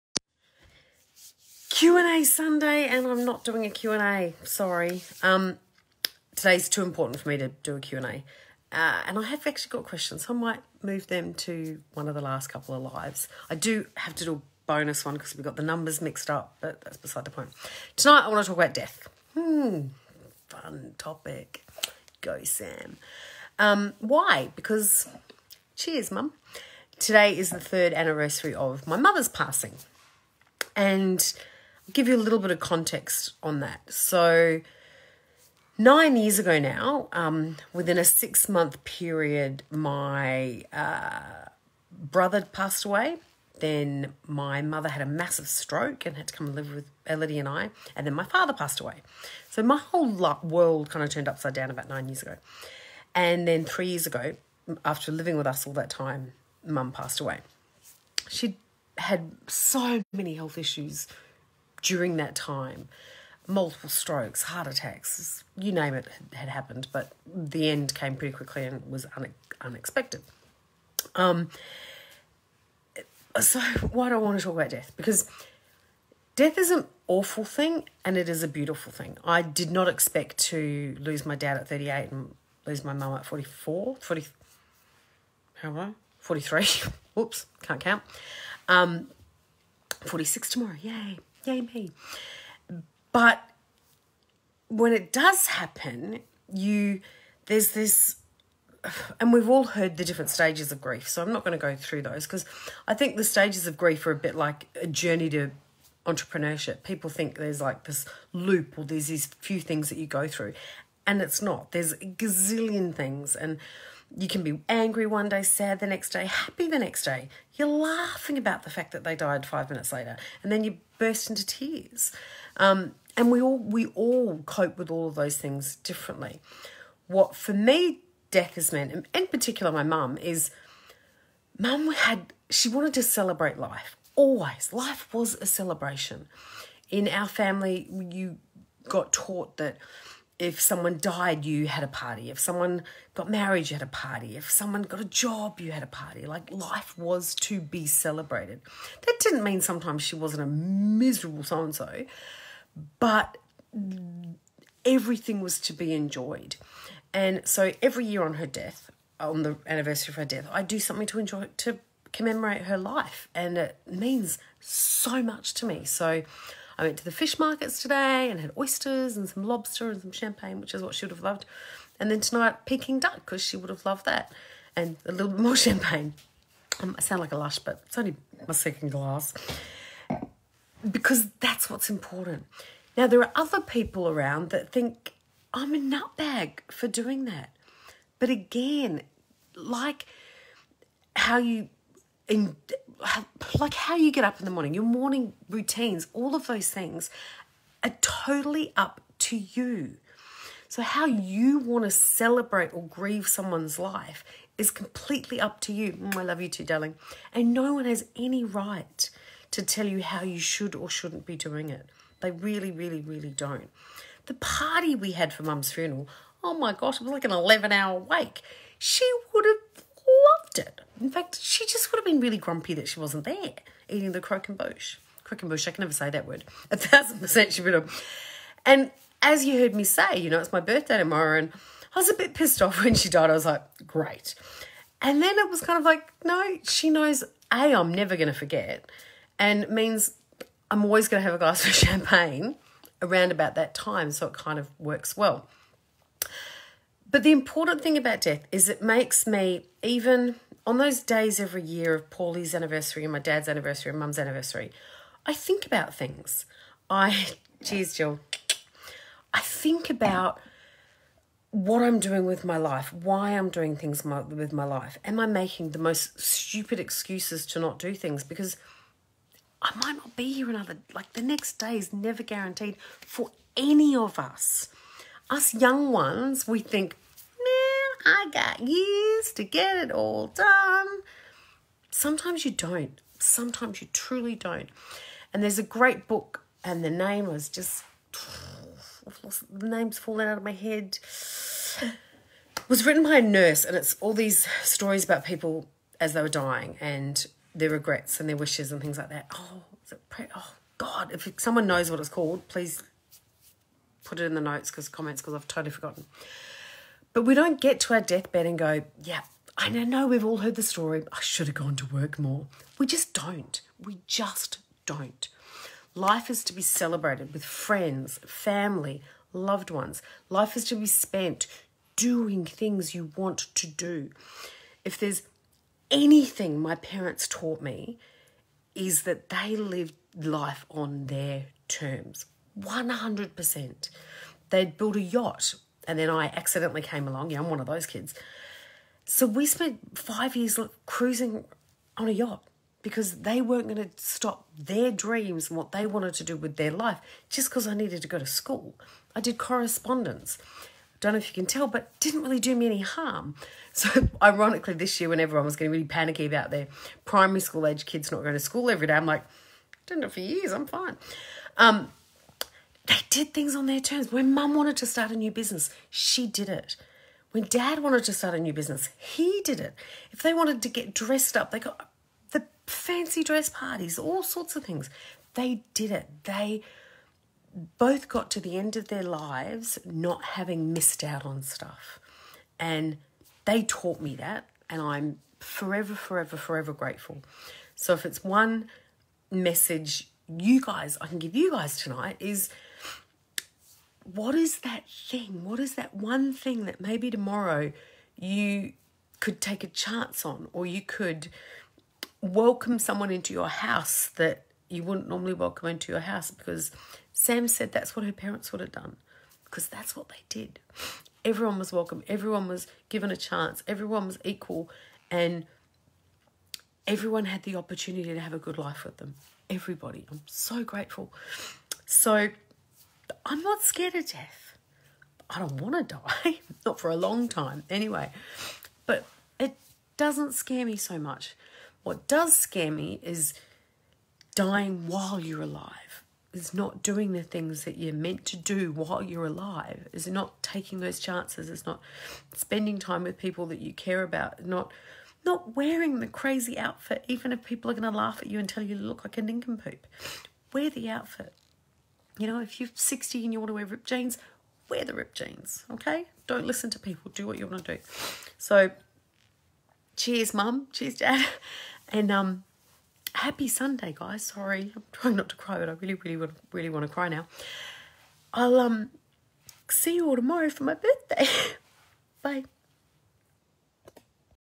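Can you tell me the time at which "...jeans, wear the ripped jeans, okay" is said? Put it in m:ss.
7:33.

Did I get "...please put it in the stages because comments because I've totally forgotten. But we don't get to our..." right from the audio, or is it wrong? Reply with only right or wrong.
wrong.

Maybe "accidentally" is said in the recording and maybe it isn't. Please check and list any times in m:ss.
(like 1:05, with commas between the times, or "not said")
5:36.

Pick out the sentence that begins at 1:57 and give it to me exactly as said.
You're laughing about the fact that they died five minutes later, and then you burst into tears.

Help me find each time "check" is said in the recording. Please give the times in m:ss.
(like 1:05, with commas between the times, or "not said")
not said.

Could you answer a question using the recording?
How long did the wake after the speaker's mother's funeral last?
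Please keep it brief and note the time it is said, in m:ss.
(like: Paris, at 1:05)
11 hours, at 3:37.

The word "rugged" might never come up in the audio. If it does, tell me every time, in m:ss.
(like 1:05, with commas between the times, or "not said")
not said.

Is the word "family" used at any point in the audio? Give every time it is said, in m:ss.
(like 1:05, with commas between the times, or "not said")
2:17, 5:18.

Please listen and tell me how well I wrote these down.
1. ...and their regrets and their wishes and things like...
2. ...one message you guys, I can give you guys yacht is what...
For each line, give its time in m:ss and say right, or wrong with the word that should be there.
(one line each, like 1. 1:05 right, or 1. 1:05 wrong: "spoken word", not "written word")
1. 4:56 right
2. 6:28 wrong: "tonight", not "yacht".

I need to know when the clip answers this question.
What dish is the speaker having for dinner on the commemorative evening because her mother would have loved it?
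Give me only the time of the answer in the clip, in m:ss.
2:52.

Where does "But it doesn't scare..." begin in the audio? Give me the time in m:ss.
7:08.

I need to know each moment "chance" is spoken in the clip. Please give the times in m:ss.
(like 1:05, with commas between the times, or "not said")
6:39, 6:53, 7:20.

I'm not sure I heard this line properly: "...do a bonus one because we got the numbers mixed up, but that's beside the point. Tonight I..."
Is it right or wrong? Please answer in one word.
right.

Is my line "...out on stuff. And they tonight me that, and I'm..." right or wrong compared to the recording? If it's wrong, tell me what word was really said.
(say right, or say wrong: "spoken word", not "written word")
wrong: "taught", not "tonight".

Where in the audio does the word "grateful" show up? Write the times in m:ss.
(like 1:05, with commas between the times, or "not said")
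6:26, 7:00.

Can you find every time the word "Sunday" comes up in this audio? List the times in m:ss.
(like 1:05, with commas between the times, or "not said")
0:02, 7:43.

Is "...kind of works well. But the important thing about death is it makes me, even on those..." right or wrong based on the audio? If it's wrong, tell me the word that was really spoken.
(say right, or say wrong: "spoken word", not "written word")
right.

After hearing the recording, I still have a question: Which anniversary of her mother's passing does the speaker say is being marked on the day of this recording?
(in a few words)
Third.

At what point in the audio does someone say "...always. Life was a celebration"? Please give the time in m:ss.
2:14.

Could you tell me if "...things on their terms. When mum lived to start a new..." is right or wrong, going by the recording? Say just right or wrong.
wrong.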